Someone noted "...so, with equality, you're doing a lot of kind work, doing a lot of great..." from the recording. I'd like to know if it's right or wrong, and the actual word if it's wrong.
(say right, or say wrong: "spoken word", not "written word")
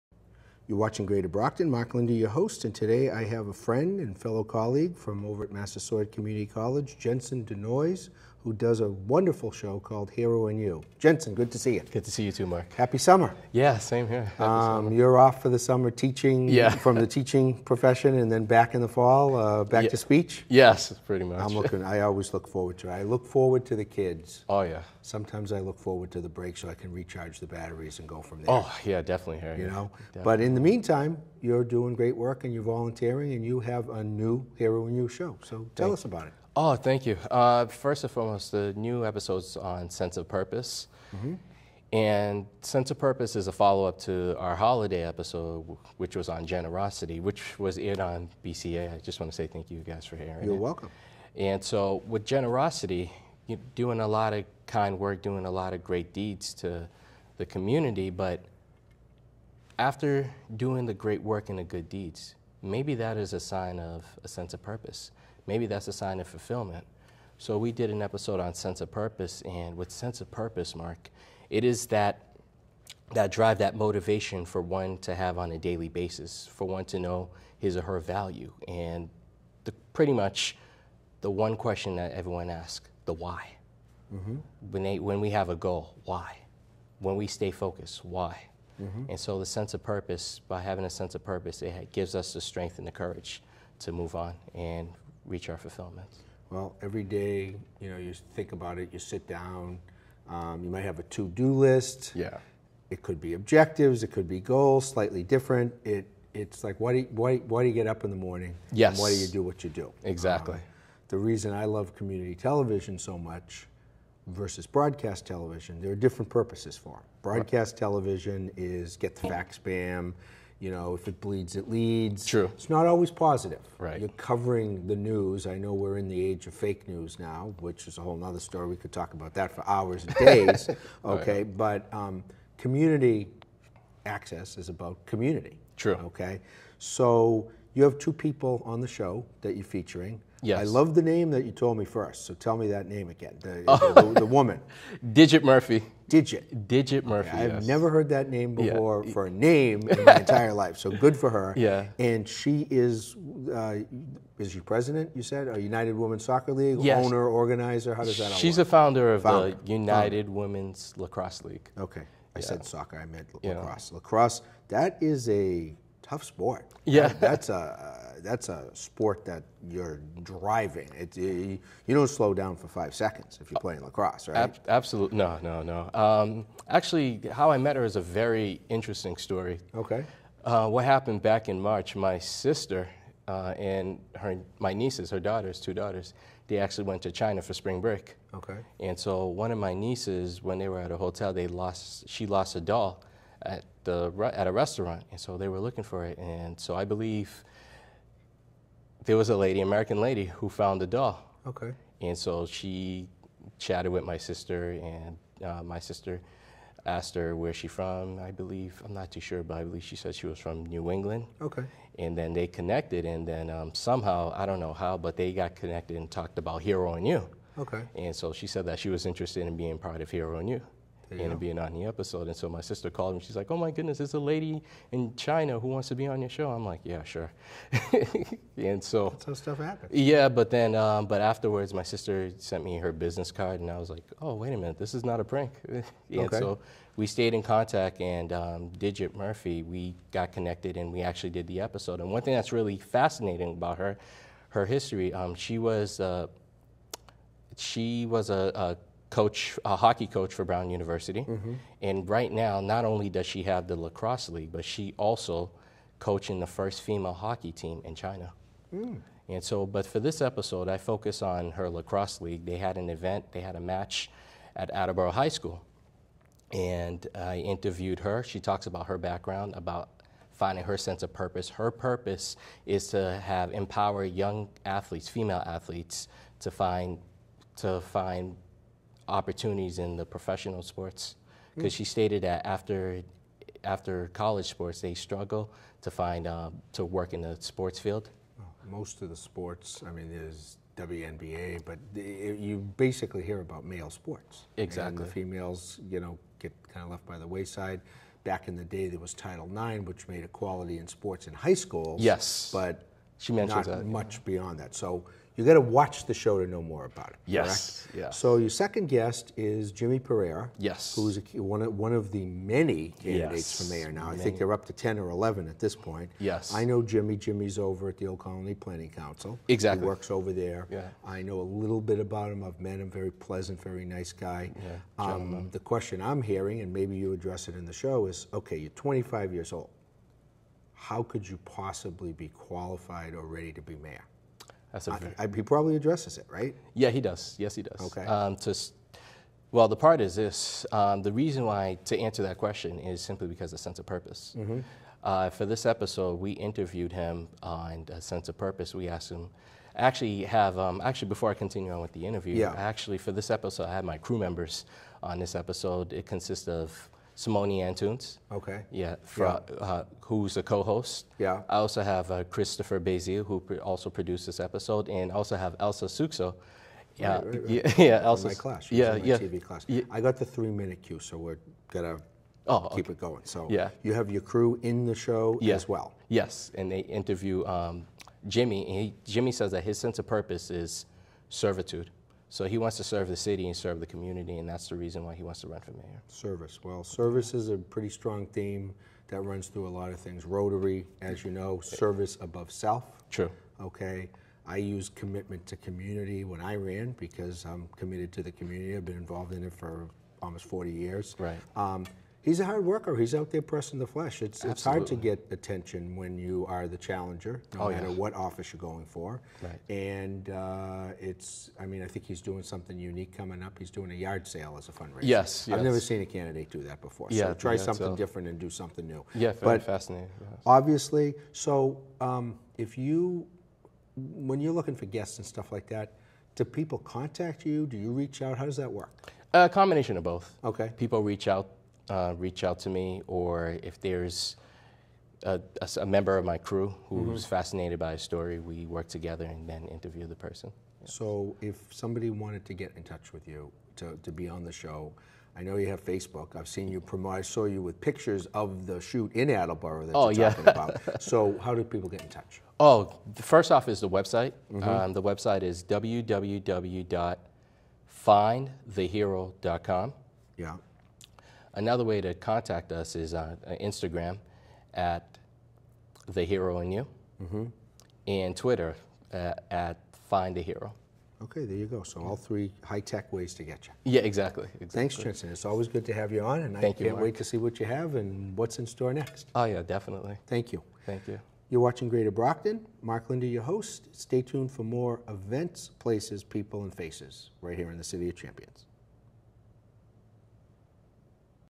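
wrong: "generosity", not "equality".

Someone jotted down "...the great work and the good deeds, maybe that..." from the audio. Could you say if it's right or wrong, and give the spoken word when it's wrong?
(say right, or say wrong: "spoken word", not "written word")
right.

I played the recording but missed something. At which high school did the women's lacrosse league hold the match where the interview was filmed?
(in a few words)
Attleboro High School.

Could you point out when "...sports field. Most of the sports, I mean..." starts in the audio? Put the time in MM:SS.
04:47.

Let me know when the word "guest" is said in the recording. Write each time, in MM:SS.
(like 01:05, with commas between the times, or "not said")
05:08, 07:04.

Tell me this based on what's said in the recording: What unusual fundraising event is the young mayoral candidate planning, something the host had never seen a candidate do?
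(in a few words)
A yard sale.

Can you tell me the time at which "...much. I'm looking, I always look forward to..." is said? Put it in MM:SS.
00:21.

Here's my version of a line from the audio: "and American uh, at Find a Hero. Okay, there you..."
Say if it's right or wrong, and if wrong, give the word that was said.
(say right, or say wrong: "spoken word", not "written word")
wrong: "Twitter", not "American".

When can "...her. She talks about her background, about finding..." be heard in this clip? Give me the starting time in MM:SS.
04:27.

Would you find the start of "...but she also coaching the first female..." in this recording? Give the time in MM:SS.
04:14.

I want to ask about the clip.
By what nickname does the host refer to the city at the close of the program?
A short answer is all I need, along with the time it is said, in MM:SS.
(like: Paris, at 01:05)
City of Champions, at 08:07.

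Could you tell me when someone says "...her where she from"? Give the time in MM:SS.
03:27.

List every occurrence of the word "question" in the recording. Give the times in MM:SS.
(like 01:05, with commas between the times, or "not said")
01:21, 05:25, 05:42.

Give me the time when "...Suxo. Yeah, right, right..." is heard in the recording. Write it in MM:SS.
06:05.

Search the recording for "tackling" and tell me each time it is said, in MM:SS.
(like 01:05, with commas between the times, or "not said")
not said.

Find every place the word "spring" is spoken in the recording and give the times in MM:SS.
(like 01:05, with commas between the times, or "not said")
03:07.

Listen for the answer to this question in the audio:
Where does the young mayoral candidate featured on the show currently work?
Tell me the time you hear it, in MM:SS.
05:18.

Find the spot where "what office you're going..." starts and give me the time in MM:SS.
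06:47.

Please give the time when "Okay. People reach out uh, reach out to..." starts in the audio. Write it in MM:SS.
07:10.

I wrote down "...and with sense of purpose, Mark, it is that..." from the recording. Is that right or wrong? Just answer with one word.
right.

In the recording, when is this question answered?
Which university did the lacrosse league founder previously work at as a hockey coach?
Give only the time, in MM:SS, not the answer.
04:10.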